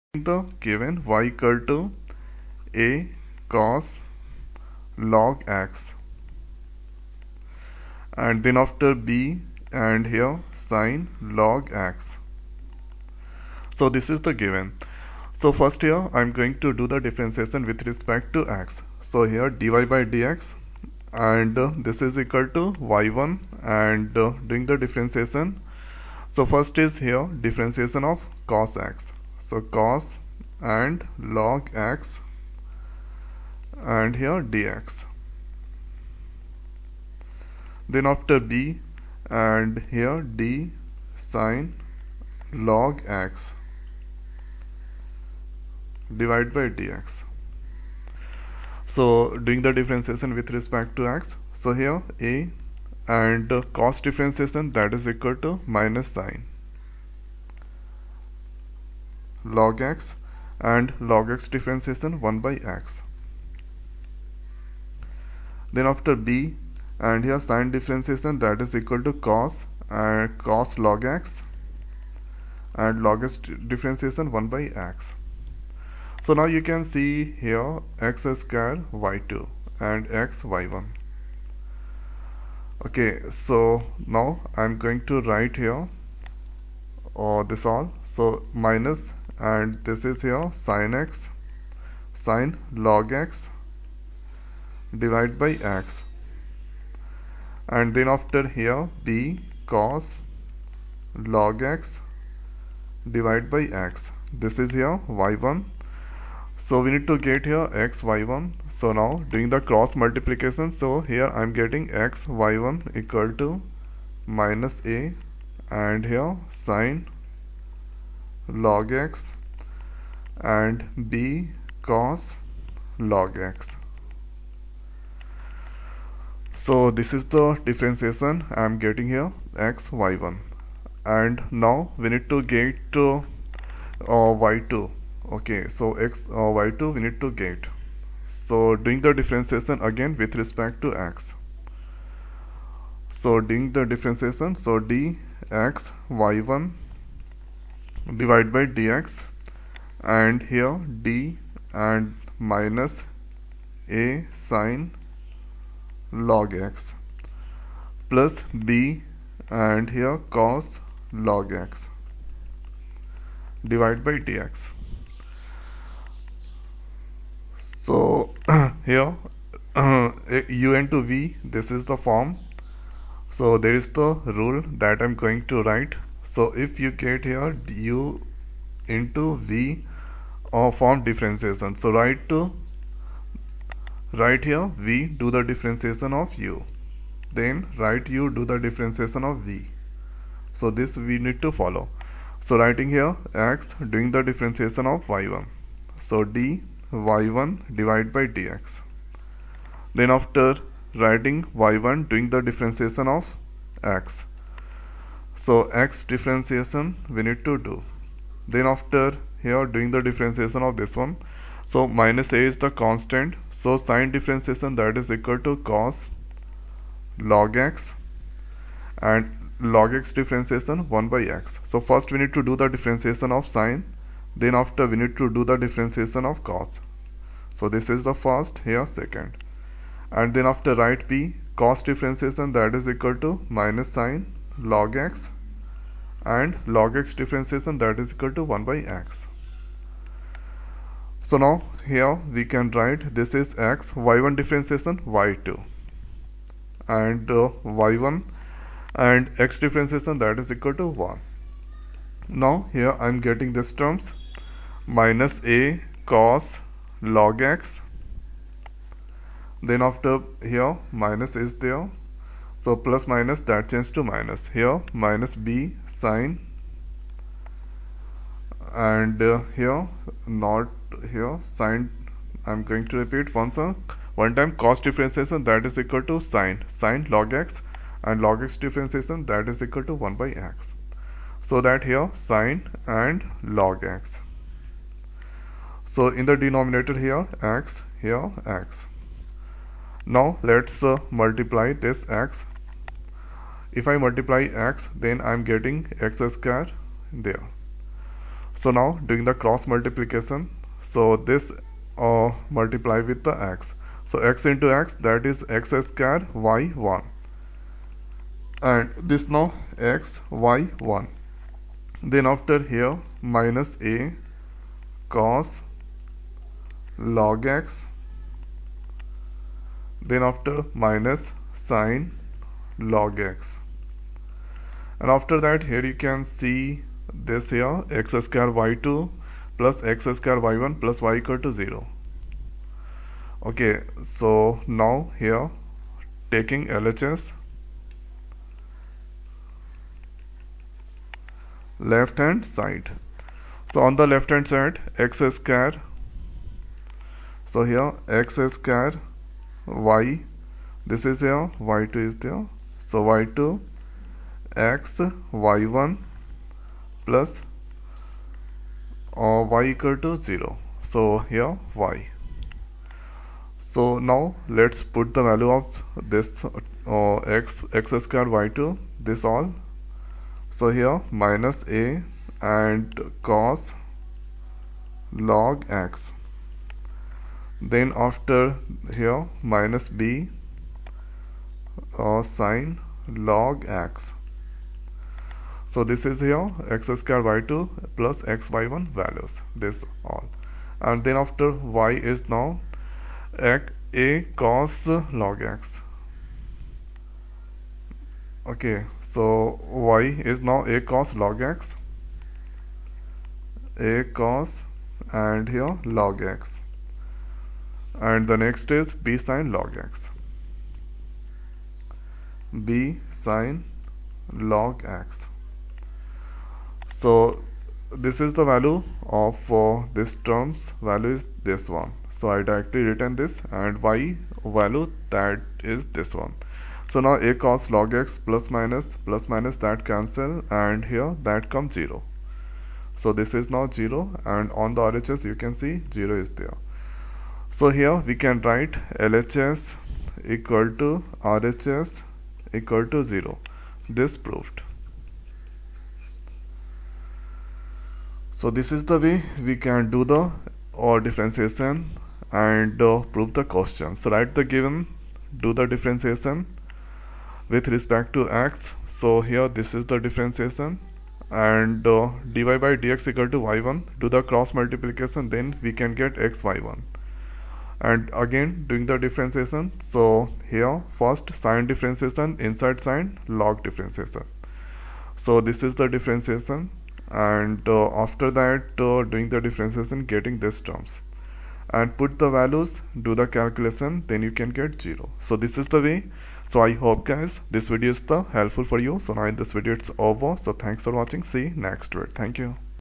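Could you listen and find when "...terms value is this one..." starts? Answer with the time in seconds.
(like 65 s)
420 s.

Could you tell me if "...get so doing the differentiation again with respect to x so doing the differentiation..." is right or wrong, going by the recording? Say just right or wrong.
right.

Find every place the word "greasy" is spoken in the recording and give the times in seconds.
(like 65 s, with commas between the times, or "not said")
not said.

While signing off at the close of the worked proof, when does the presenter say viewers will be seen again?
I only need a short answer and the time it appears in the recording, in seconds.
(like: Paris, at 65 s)
next week, at 491 s.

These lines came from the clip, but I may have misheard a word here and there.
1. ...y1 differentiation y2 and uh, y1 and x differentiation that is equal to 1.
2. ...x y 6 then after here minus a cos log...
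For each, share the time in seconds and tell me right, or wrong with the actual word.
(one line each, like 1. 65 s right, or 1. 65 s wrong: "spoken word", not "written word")
1. 243 s right
2. 309 s wrong: "1", not "6".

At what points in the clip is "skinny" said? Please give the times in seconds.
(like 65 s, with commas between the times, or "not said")
not said.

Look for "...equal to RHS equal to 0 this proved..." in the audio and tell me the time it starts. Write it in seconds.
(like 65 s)
440 s.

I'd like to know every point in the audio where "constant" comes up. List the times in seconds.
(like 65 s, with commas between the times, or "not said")
212 s.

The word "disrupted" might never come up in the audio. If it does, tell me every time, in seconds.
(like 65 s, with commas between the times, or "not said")
not said.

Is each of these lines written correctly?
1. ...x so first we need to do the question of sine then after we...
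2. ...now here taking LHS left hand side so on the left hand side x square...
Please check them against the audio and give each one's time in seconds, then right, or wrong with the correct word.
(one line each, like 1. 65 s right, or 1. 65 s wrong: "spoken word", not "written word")
1. 221 s wrong: "differentiation", not "question"
2. 334 s right.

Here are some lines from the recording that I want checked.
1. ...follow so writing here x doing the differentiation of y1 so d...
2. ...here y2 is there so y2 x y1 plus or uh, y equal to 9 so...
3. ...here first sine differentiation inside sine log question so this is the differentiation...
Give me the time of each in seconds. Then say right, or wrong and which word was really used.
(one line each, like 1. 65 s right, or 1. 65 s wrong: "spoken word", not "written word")
1. 191 s right
2. 351 s wrong: "0", not "9"
3. 470 s wrong: "differentiation", not "question".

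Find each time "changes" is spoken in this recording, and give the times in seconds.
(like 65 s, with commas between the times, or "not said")
263 s.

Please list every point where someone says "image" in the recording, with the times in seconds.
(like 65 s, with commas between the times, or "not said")
not said.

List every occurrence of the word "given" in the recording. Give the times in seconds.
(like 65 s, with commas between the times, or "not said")
0 s, 14 s, 454 s.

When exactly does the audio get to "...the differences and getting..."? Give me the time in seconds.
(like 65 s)
479 s.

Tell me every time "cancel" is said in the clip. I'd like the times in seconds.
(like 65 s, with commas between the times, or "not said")
429 s.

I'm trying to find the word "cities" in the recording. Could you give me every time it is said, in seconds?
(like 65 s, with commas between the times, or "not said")
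not said.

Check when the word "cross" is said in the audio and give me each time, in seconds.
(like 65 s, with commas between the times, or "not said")
109 s, 299 s, 464 s.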